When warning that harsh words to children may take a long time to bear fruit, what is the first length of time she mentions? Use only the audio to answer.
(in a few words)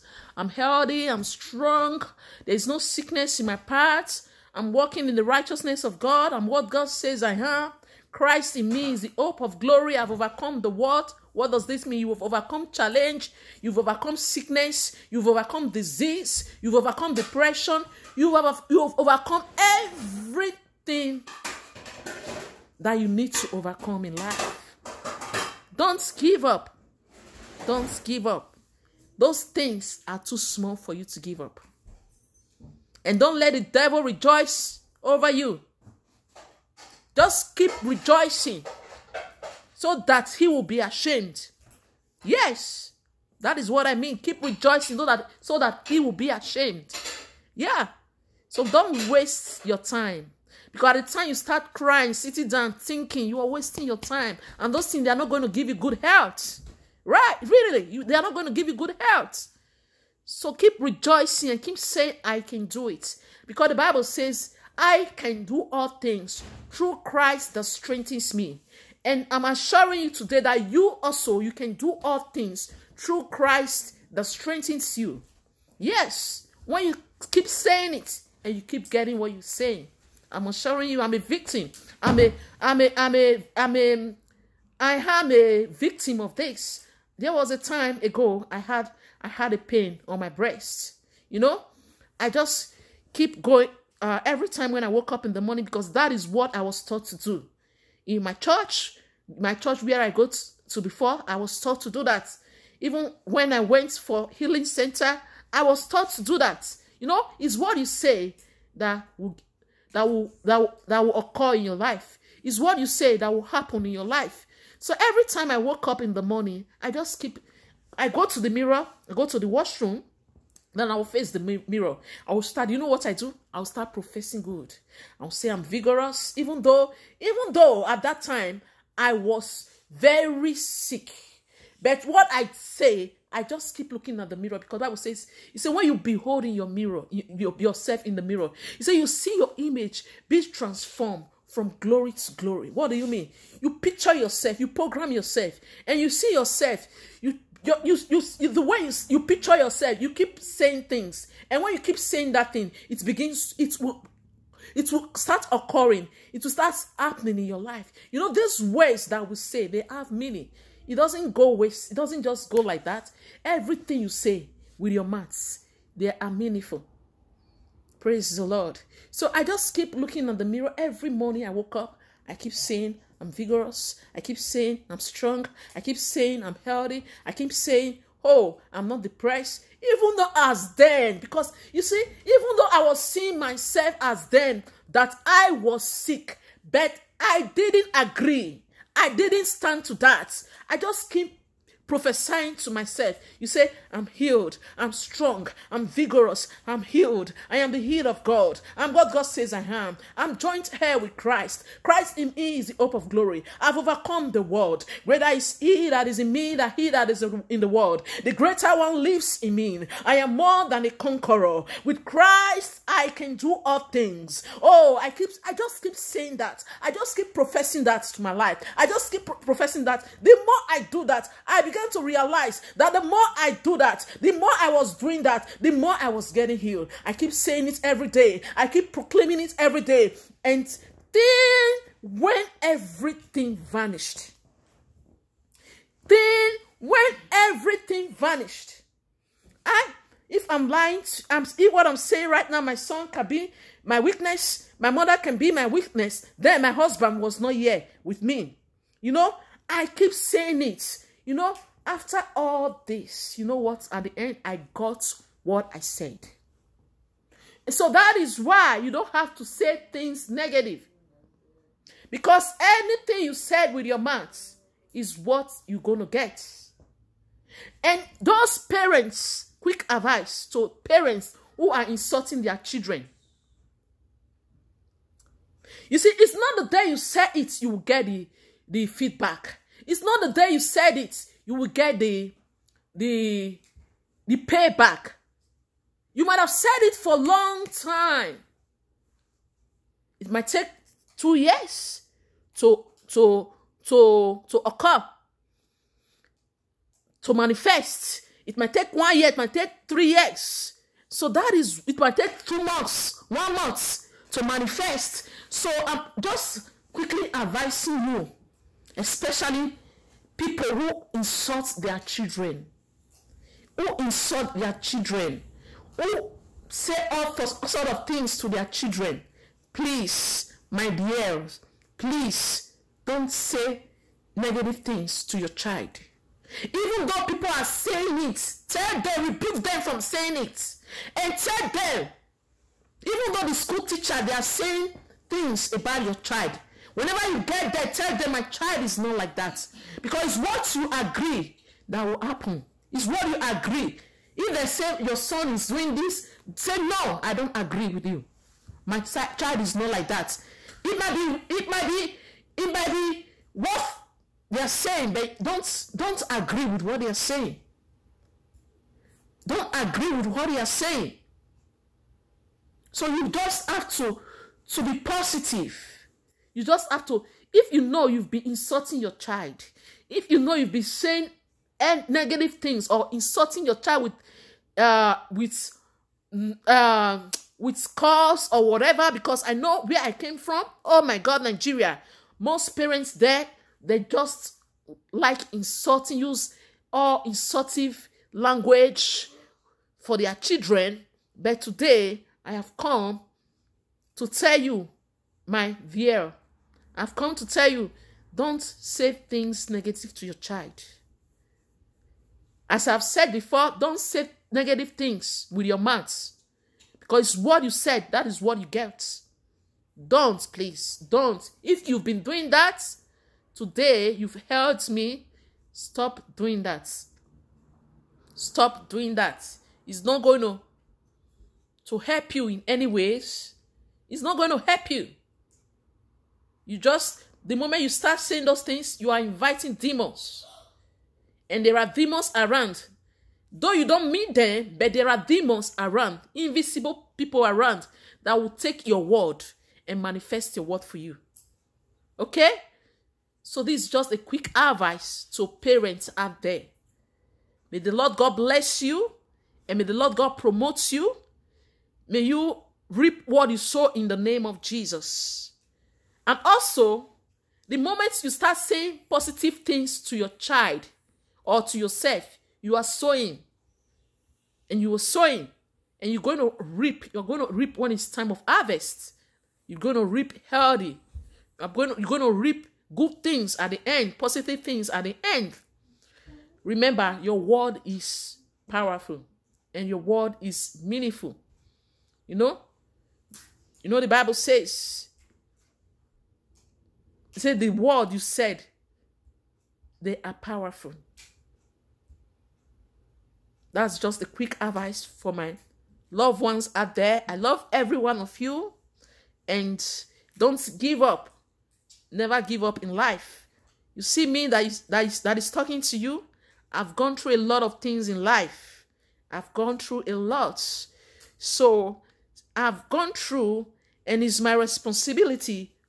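2 years.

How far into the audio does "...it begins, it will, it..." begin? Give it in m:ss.
2:32.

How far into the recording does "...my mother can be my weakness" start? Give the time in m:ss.
4:04.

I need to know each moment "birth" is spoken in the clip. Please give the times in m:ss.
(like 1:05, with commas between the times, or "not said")
not said.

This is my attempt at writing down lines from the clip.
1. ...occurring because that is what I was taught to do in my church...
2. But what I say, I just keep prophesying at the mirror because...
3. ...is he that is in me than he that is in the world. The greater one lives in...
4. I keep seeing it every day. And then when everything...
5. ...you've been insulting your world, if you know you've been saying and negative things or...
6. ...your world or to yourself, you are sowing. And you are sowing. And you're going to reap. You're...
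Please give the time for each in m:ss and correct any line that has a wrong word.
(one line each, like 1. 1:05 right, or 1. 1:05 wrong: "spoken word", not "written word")
1. 1:35 wrong: "morning", not "occurring"
2. 2:11 wrong: "looking", not "prophesying"
3. 3:25 right
4. 3:48 wrong: "proclaiming", not "seeing"
5. 6:08 wrong: "child", not "world"
6. 7:40 wrong: "child", not "world".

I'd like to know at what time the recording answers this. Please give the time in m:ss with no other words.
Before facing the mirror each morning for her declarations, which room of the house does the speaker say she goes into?
1:59.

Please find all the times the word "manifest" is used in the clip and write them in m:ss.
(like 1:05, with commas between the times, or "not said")
4:57, 5:04, 7:20.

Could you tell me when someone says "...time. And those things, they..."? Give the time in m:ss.
0:53.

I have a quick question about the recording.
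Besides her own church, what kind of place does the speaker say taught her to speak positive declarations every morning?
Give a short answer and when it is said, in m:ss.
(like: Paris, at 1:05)
healing center, at 1:44.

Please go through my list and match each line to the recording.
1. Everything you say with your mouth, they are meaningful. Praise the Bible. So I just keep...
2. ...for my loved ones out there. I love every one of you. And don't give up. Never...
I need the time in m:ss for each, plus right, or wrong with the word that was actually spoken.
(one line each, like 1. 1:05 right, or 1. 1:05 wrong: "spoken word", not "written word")
1. 2:43 wrong: "Lord", not "Bible"
2. 8:15 right.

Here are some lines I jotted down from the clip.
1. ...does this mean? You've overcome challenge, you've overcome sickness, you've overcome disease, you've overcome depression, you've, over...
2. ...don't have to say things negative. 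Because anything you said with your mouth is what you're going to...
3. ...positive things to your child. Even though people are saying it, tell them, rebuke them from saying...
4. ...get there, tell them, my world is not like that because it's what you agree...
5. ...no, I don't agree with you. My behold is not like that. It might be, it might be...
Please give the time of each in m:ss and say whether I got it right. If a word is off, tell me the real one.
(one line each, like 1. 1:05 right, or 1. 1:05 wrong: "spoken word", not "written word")
1. 0:11 right
2. 4:18 right
3. 5:24 wrong: "negative", not "positive"
4. 5:37 wrong: "child", not "world"
5. 5:46 wrong: "child", not "behold".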